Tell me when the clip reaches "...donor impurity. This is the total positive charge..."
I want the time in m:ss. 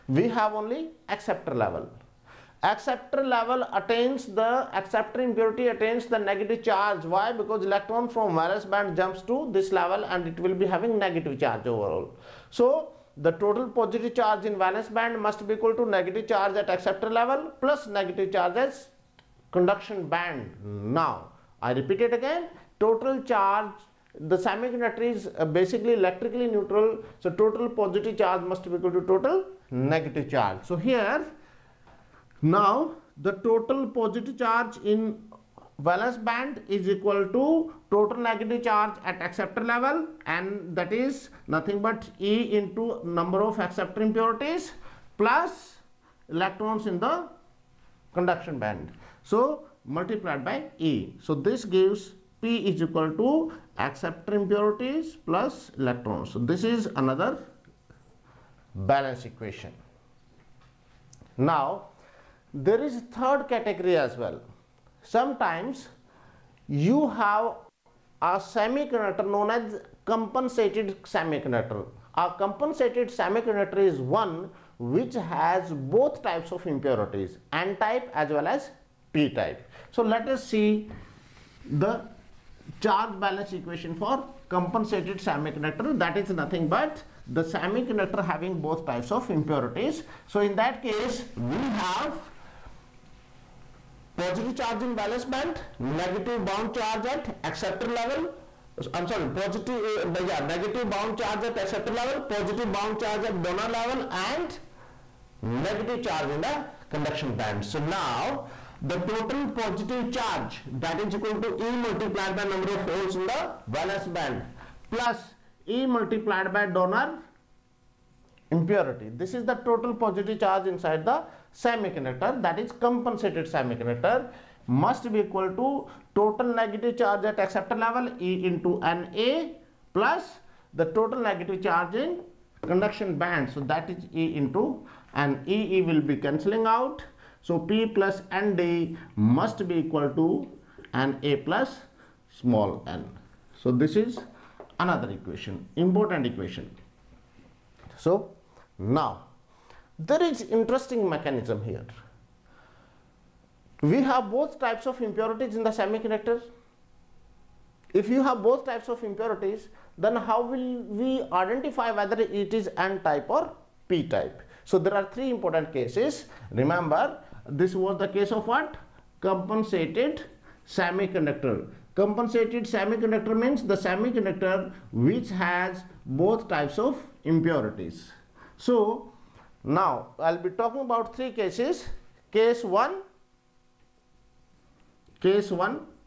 1:56.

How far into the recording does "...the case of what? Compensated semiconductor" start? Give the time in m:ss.
2:47.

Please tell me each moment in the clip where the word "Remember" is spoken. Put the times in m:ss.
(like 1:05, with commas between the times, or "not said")
2:46.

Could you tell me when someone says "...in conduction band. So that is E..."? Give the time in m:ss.
2:11.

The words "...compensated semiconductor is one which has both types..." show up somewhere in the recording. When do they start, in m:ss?
1:12.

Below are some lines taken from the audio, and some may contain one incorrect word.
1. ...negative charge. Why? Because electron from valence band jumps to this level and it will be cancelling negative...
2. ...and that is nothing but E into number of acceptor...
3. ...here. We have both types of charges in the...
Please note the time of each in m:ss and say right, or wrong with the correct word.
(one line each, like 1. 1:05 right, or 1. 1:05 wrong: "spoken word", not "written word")
1. 0:06 wrong: "having", not "cancelling"
2. 0:40 right
3. 2:31 wrong: "impurities", not "charges".